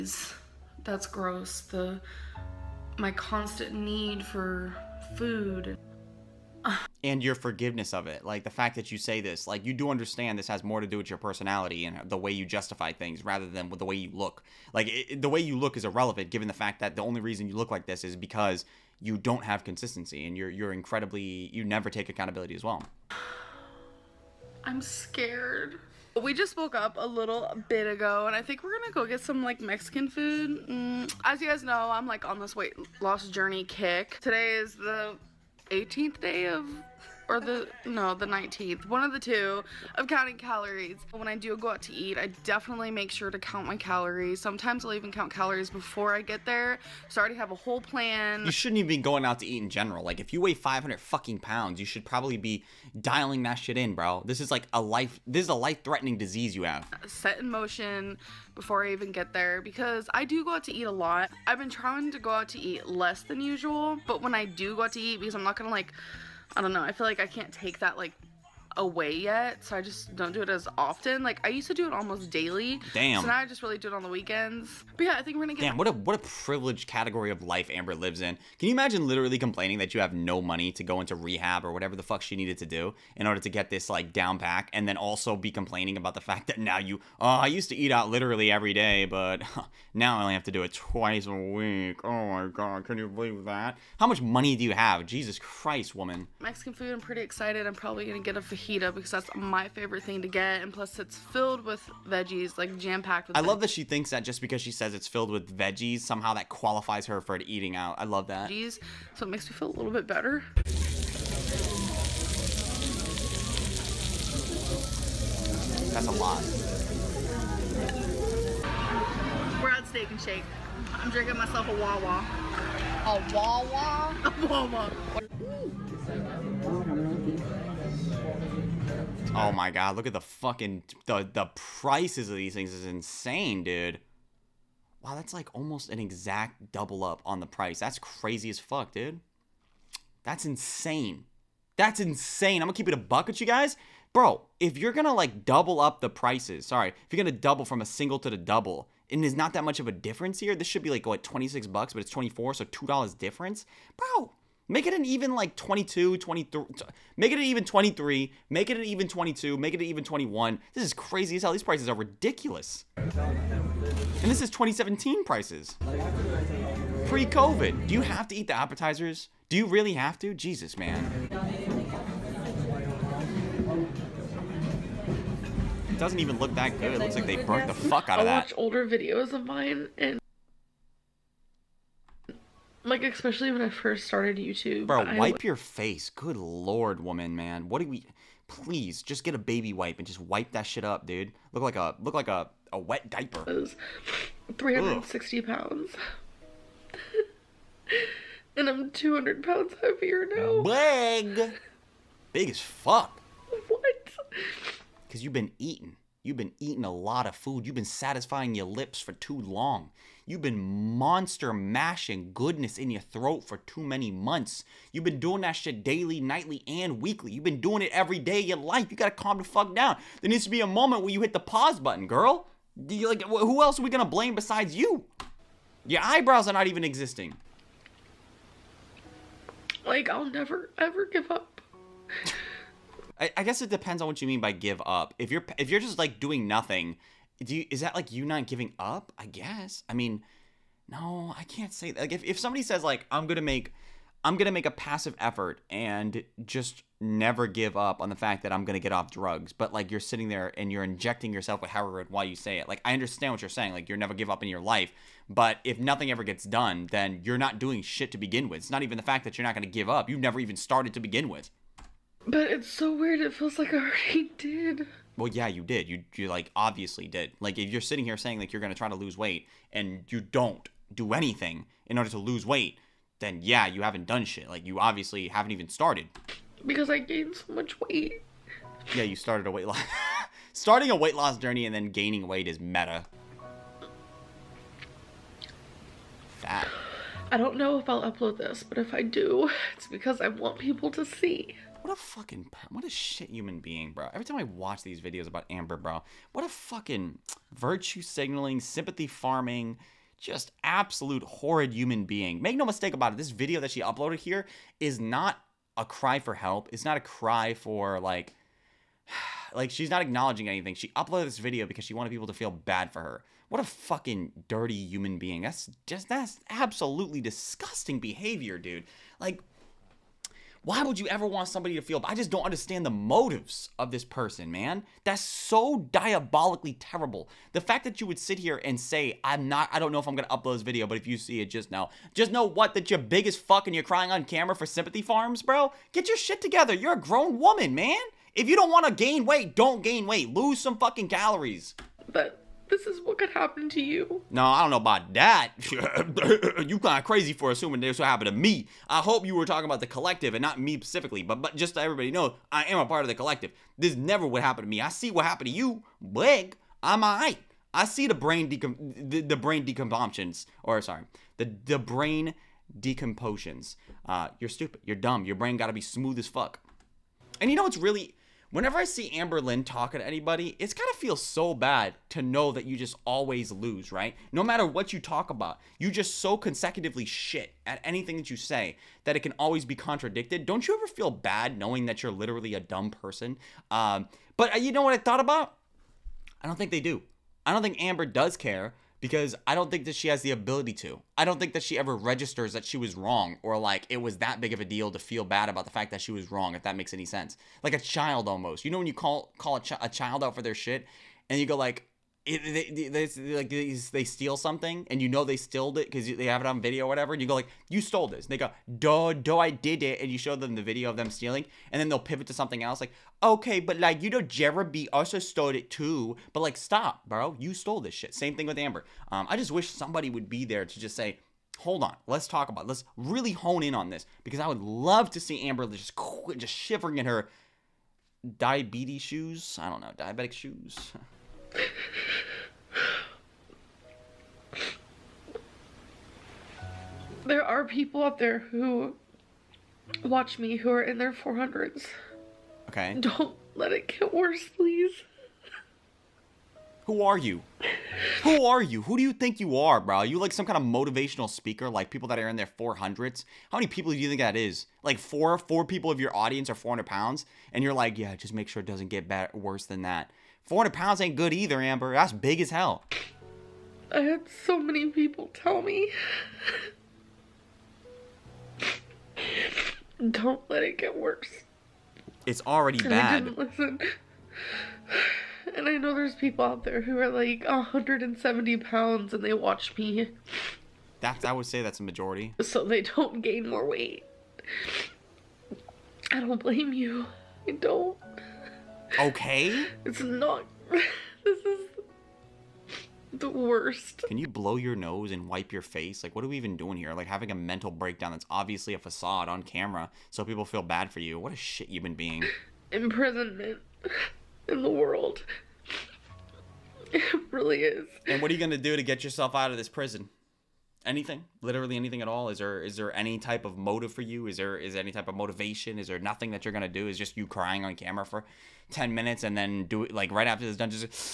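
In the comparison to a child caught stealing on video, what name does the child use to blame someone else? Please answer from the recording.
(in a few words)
Jeremy.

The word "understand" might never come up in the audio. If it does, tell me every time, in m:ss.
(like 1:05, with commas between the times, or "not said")
0:09, 4:12, 5:22.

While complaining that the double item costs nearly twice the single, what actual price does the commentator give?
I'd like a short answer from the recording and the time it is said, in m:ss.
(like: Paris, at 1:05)
24, at 2:32.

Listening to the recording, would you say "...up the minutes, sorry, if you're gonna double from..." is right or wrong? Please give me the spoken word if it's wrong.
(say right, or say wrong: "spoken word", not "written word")
wrong: "prices", not "minutes".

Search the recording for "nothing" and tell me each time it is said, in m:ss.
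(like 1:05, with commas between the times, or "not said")
3:56, 4:15, 8:35.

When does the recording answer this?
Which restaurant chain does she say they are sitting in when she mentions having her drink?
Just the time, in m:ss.
1:59.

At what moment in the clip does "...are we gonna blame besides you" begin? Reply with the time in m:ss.
3:43.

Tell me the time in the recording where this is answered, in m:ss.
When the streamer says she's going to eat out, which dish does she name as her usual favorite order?
1:38.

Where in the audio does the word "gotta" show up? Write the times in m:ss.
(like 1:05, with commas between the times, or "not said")
3:38, 6:10.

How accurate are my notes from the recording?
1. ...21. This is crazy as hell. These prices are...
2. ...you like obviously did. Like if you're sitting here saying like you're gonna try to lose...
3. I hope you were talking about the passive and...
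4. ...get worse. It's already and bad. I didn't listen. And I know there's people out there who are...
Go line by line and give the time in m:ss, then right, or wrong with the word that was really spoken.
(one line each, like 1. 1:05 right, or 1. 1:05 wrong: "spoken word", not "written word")
1. 2:40 right
2. 4:26 right
3. 5:48 wrong: "collective", not "passive"
4. 7:50 right.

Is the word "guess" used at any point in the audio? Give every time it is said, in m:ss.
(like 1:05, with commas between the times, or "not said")
3:53, 3:59.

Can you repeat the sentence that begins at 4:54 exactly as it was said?
Every time I watch these videos about Amber, bro, what a fucking virtue signaling, sympathy farming, just absolute horrid human being.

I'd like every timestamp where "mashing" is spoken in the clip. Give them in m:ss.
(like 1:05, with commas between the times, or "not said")
3:31.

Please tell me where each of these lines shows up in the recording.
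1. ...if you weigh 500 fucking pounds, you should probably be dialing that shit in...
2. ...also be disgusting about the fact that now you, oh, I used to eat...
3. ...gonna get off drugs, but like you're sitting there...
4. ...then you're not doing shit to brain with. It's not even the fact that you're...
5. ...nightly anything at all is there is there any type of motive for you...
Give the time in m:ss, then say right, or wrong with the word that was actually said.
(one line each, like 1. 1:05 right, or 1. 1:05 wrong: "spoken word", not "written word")
1. 0:50 right
2. 1:24 wrong: "complaining", not "disgusting"
3. 4:08 right
4. 4:16 wrong: "begin", not "brain"
5. 8:31 wrong: "literally", not "nightly".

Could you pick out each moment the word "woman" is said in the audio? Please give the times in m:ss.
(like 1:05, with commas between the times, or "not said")
1:35, 3:07, 5:37.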